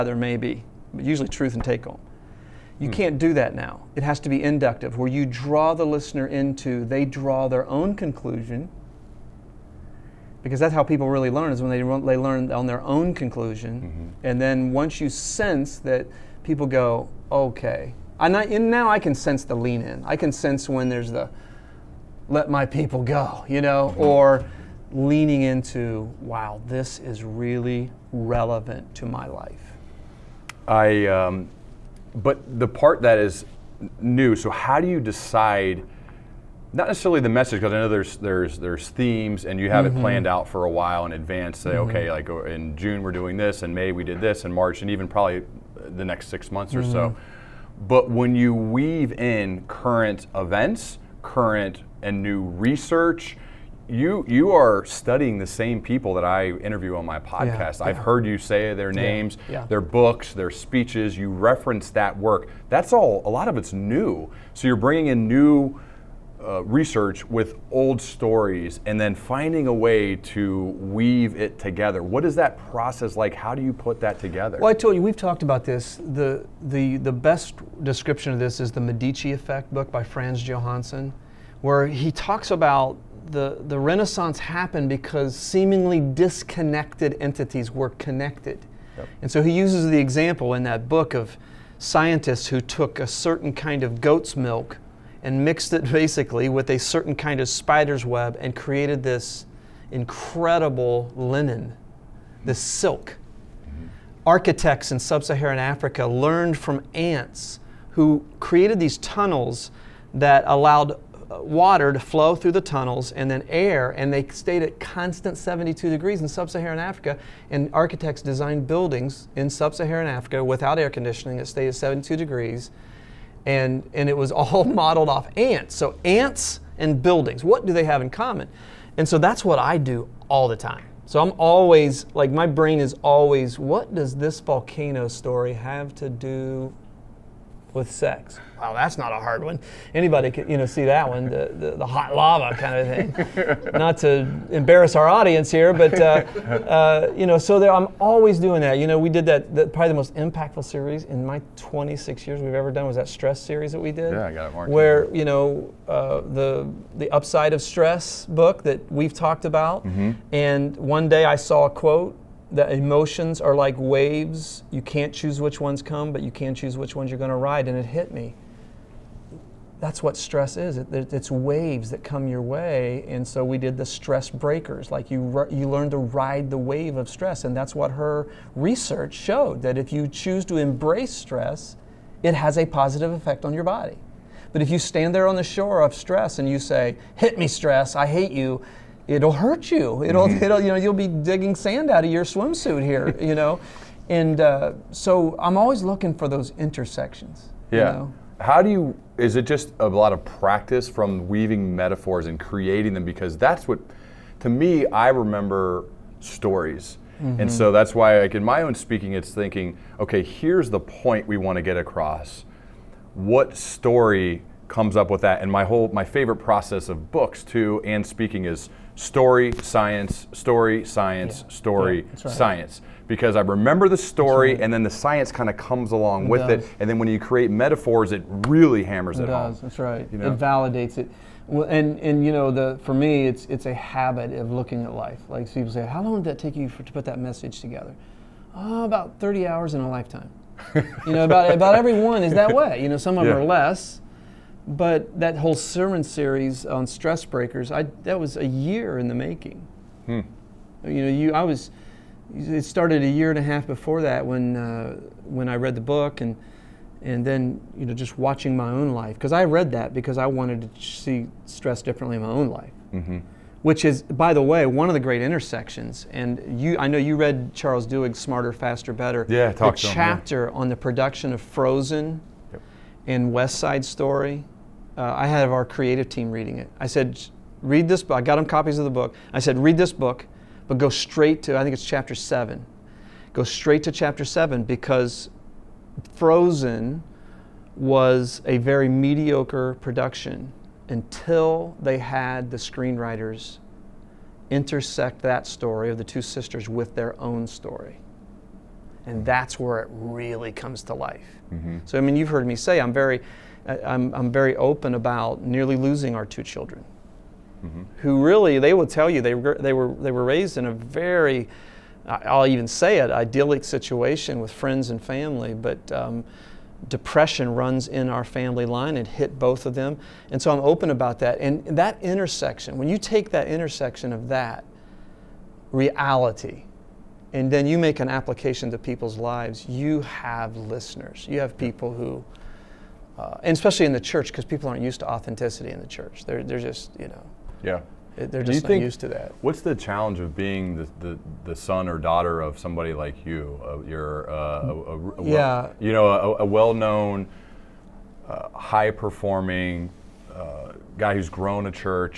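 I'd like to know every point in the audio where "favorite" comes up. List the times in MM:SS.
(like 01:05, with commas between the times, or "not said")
03:36.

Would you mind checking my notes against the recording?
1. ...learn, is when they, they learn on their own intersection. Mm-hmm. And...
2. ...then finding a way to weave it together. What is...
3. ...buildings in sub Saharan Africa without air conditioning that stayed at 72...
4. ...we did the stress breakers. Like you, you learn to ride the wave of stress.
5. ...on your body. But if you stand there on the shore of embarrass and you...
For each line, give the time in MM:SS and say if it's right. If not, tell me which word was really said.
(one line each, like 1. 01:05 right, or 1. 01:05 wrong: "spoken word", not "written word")
1. 00:11 wrong: "conclusion", not "intersection"
2. 01:08 right
3. 01:58 right
4. 02:53 right
5. 03:03 wrong: "stress", not "embarrass".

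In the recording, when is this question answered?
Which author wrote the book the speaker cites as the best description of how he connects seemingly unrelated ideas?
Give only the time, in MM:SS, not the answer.
01:20.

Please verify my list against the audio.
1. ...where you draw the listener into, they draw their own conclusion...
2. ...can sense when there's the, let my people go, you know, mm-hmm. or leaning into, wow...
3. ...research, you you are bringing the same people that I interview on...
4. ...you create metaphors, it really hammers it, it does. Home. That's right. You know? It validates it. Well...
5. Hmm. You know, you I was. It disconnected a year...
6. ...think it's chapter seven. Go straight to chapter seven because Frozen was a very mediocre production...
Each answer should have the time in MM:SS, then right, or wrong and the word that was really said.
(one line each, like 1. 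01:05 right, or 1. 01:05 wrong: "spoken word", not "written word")
1. 00:04 right
2. 00:20 right
3. 00:52 wrong: "studying", not "bringing"
4. 03:47 right
5. 04:10 wrong: "started", not "disconnected"
6. 04:41 right.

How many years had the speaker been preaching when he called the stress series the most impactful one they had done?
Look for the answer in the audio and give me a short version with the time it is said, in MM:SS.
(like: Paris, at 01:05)
26, at 02:31.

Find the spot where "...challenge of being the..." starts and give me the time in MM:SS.
05:39.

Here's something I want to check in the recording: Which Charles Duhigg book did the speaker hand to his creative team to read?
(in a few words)
Smarter, Faster, Better.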